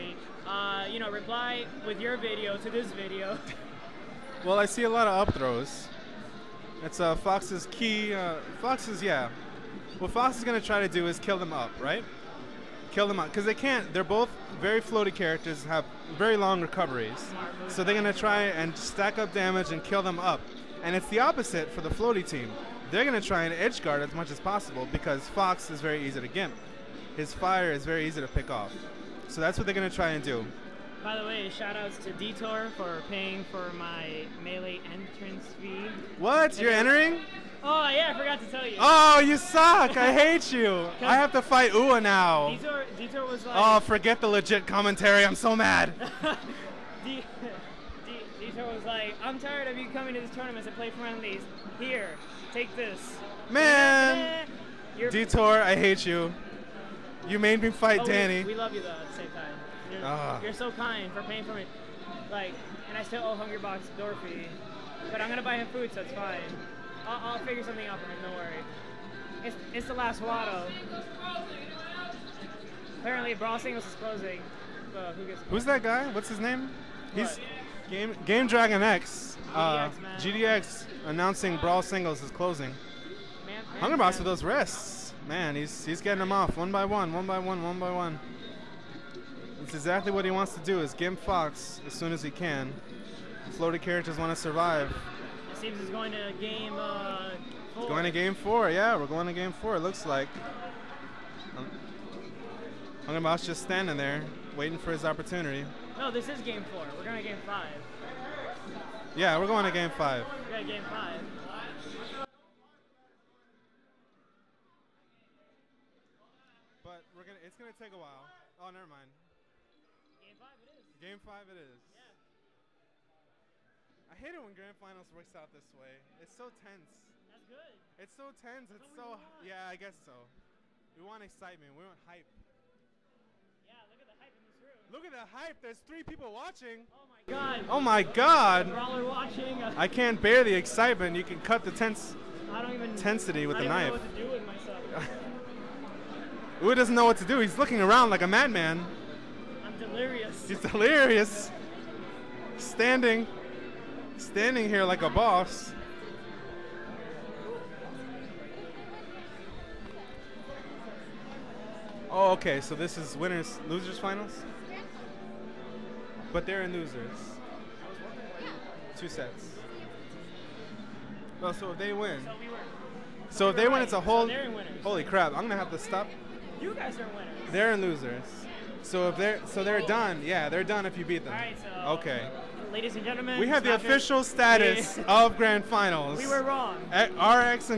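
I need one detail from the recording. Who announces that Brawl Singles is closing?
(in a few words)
Game Dragon X.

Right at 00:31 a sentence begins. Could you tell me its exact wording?
By the way, shout outs to Detour for paying for my melee entrance fee.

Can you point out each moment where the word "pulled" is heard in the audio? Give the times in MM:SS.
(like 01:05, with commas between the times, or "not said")
not said.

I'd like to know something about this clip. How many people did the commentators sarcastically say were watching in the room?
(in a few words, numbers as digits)
3.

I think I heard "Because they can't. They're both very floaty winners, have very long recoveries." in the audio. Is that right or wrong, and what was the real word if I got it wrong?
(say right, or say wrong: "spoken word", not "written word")
wrong: "characters", not "winners".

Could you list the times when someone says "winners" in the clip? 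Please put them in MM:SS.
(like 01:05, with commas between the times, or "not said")
02:43, 02:57.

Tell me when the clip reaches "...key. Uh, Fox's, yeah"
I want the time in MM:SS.
00:07.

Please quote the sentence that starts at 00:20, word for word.
And it's the opposite for the floaty team.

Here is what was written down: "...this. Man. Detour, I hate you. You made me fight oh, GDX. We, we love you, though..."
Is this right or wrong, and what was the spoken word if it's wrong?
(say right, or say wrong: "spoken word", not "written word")
wrong: "Danny", not "GDX".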